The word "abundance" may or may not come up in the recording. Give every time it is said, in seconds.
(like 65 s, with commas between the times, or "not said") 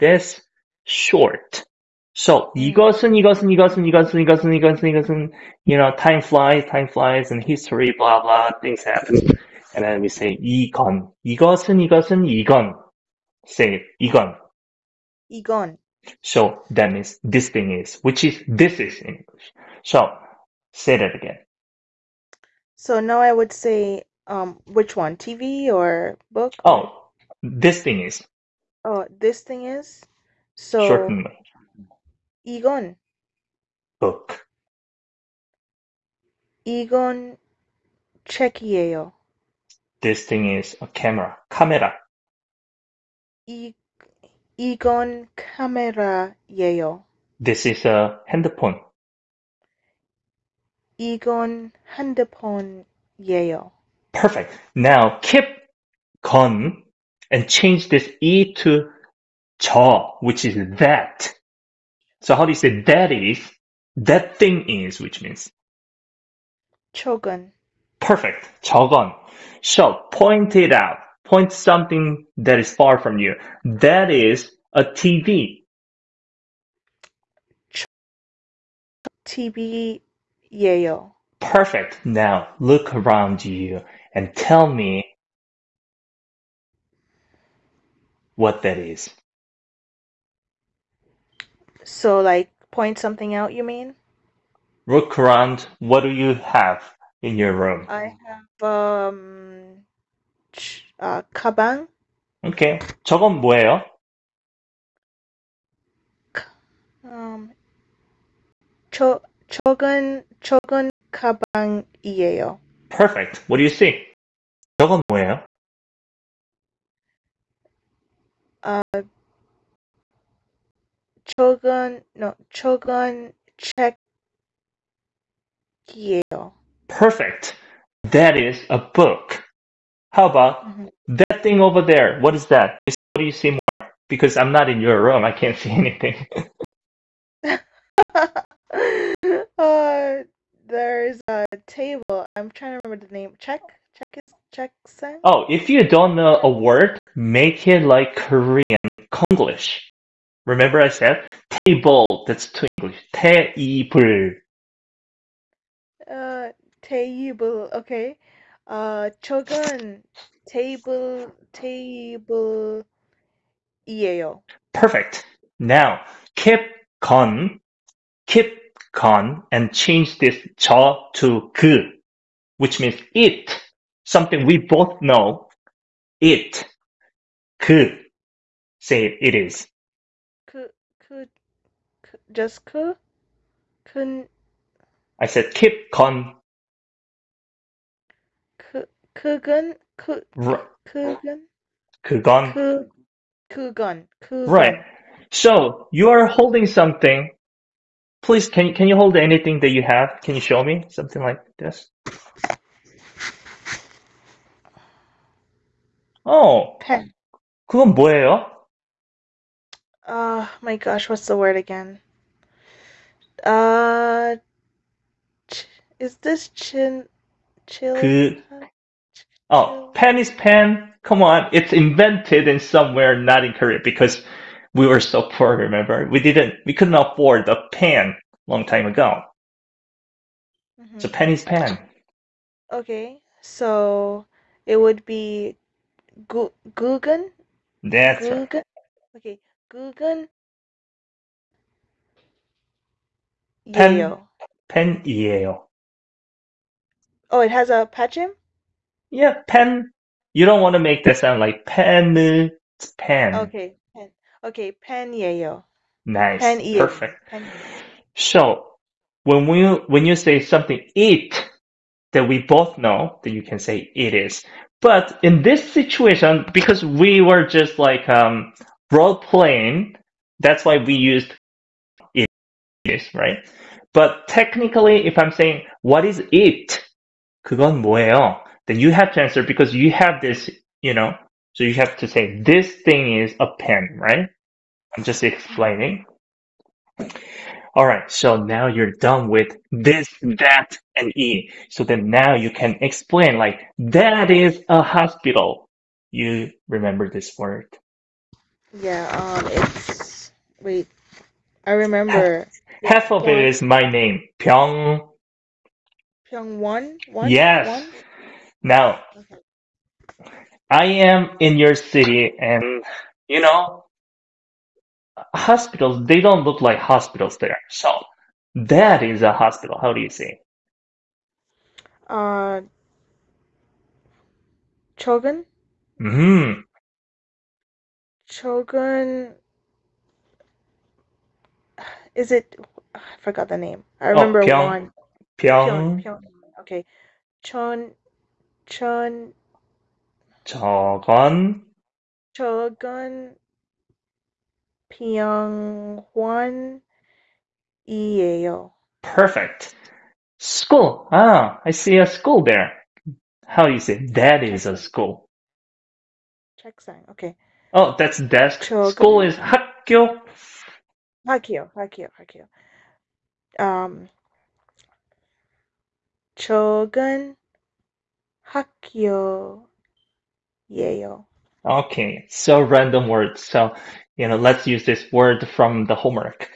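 not said.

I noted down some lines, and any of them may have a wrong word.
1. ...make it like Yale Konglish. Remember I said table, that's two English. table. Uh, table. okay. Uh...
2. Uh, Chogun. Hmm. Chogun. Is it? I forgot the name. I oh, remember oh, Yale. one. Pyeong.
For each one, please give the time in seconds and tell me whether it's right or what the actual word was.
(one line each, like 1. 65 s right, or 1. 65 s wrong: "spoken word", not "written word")
1. 147 s wrong: "Korean", not "Yale"
2. 322 s wrong: "Pyong", not "Yale".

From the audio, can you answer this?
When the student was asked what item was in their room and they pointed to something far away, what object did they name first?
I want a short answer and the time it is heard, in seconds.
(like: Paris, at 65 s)
가방, at 101 s.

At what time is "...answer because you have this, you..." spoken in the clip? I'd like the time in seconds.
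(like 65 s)
279 s.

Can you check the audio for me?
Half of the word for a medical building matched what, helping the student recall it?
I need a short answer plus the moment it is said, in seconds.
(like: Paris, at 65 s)
My name, at 302 s.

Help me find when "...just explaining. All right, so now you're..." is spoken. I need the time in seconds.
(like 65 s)
285 s.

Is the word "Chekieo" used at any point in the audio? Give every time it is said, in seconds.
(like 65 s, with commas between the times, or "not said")
123 s.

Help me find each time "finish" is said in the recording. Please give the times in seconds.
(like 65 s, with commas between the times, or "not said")
not said.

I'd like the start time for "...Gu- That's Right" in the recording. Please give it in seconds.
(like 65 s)
236 s.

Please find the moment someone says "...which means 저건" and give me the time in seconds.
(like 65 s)
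64 s.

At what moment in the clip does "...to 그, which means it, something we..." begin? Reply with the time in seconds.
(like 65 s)
171 s.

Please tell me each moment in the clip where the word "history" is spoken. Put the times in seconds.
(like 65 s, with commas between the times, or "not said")
7 s.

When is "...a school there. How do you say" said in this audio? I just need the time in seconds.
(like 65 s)
351 s.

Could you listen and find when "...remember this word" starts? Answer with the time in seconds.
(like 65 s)
296 s.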